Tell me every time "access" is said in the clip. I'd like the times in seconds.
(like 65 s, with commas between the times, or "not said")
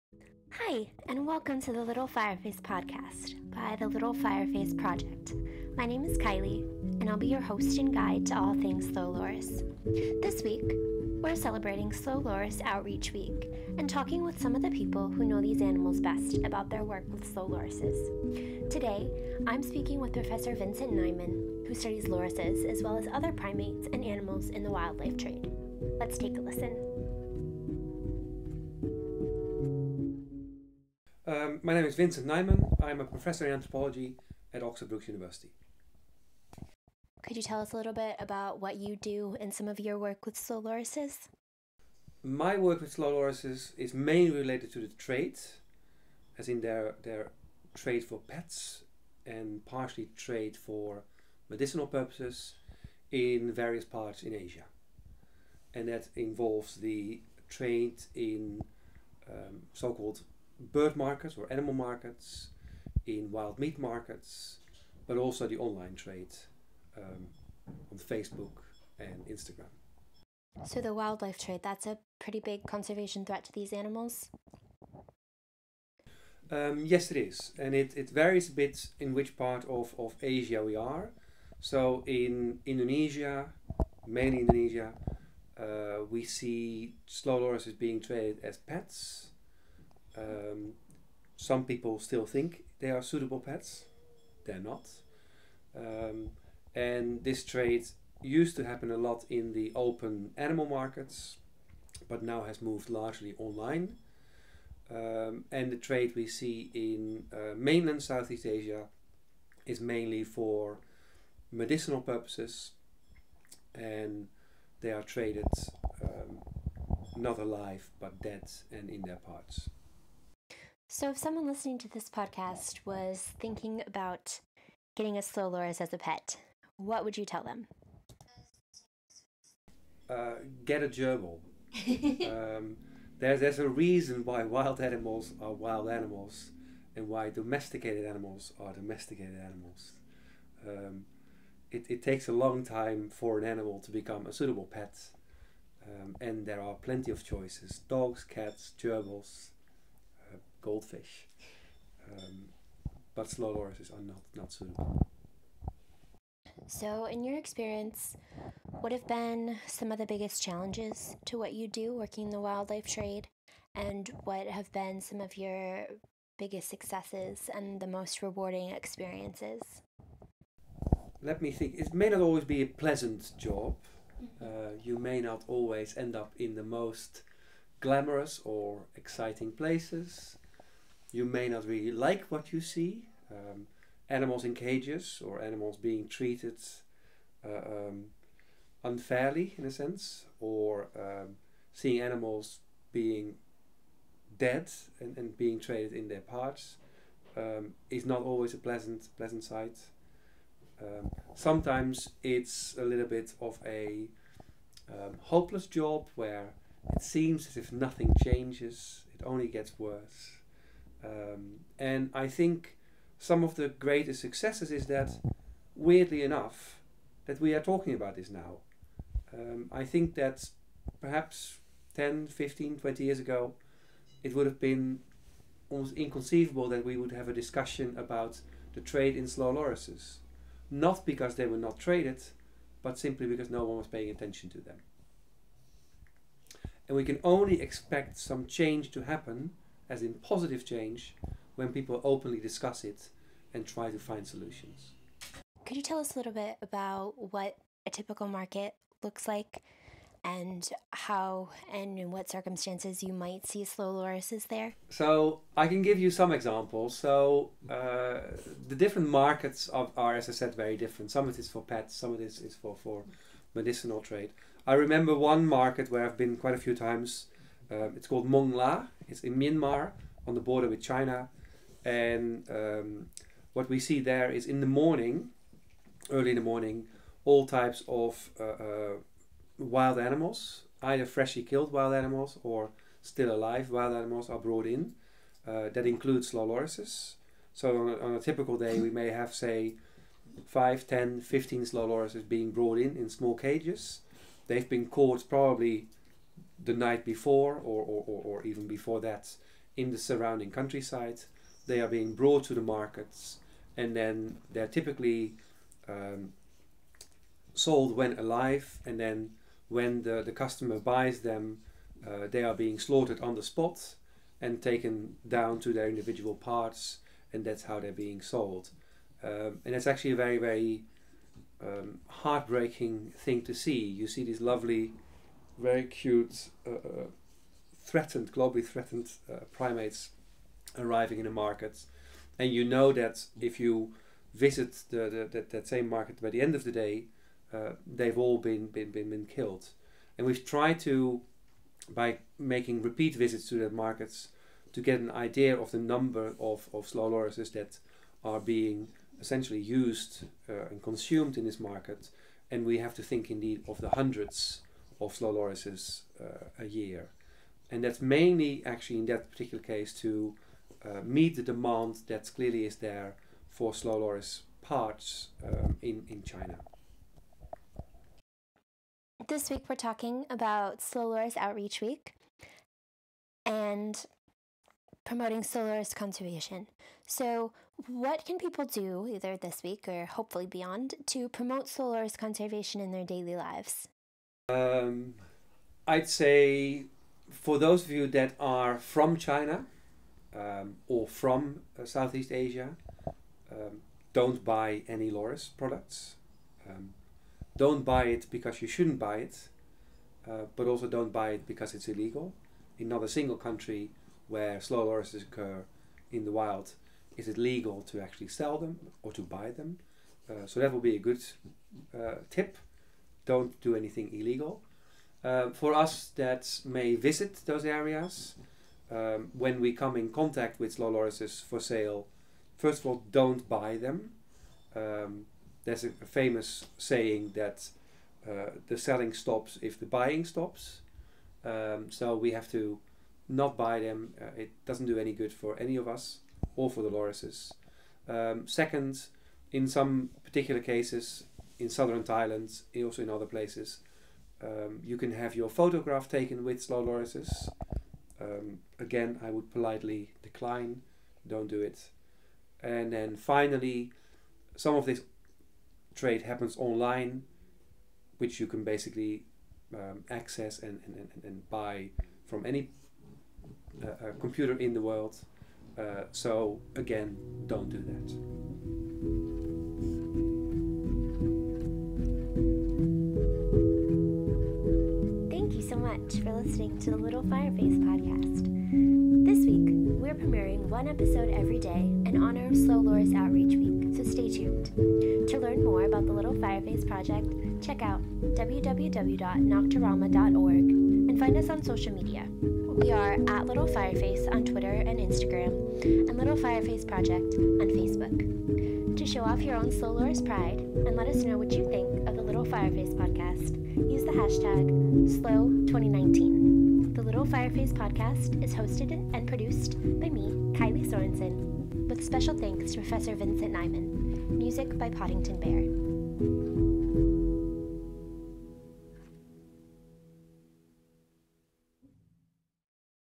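460 s.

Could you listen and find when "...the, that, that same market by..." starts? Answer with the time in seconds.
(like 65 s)
335 s.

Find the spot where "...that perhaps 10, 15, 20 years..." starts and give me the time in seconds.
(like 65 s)
220 s.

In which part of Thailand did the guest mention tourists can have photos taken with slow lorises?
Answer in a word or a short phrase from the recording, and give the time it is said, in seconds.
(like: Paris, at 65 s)
southern Thailand, at 441 s.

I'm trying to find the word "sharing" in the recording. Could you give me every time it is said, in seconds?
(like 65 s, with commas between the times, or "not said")
not said.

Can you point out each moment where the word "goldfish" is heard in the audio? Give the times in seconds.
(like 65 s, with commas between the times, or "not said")
150 s.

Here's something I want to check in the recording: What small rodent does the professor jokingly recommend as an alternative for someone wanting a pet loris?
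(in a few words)
a gerbil.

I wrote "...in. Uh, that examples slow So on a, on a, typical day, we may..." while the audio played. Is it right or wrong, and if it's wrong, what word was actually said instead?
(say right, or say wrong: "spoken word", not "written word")
wrong: "includes", not "examples".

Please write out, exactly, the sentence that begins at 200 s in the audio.
Um, sometimes it's a little bit of a um, hopeless job where it seems as if nothing changes, it only gets worse.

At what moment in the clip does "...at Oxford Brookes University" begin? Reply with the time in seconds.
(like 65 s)
34 s.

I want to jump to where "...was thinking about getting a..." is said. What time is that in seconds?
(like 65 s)
122 s.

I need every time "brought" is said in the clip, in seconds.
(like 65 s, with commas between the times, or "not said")
284 s, 292 s, 302 s.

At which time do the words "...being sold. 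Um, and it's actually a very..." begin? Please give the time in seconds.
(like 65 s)
317 s.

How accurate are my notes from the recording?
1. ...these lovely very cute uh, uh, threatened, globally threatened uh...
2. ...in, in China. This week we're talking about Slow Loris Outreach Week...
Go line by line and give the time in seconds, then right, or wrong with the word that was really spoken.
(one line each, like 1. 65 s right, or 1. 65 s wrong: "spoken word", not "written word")
1. 324 s right
2. 365 s right.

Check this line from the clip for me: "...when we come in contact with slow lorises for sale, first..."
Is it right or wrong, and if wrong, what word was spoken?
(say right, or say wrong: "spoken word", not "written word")
right.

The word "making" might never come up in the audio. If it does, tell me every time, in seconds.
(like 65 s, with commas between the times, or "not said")
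342 s.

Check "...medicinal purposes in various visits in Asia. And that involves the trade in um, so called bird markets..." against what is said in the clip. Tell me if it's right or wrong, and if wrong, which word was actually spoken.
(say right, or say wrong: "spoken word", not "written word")
wrong: "parts", not "visits".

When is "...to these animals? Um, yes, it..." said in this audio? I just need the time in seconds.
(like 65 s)
73 s.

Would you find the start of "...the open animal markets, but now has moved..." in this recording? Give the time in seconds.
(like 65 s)
99 s.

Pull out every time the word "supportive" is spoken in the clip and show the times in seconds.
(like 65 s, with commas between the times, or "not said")
not said.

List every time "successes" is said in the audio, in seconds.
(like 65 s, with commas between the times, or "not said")
166 s, 214 s.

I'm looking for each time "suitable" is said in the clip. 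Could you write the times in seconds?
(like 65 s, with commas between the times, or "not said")
93 s, 144 s, 154 s.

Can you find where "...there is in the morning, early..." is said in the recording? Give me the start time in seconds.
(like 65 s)
274 s.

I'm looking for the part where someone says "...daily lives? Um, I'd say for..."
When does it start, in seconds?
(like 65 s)
383 s.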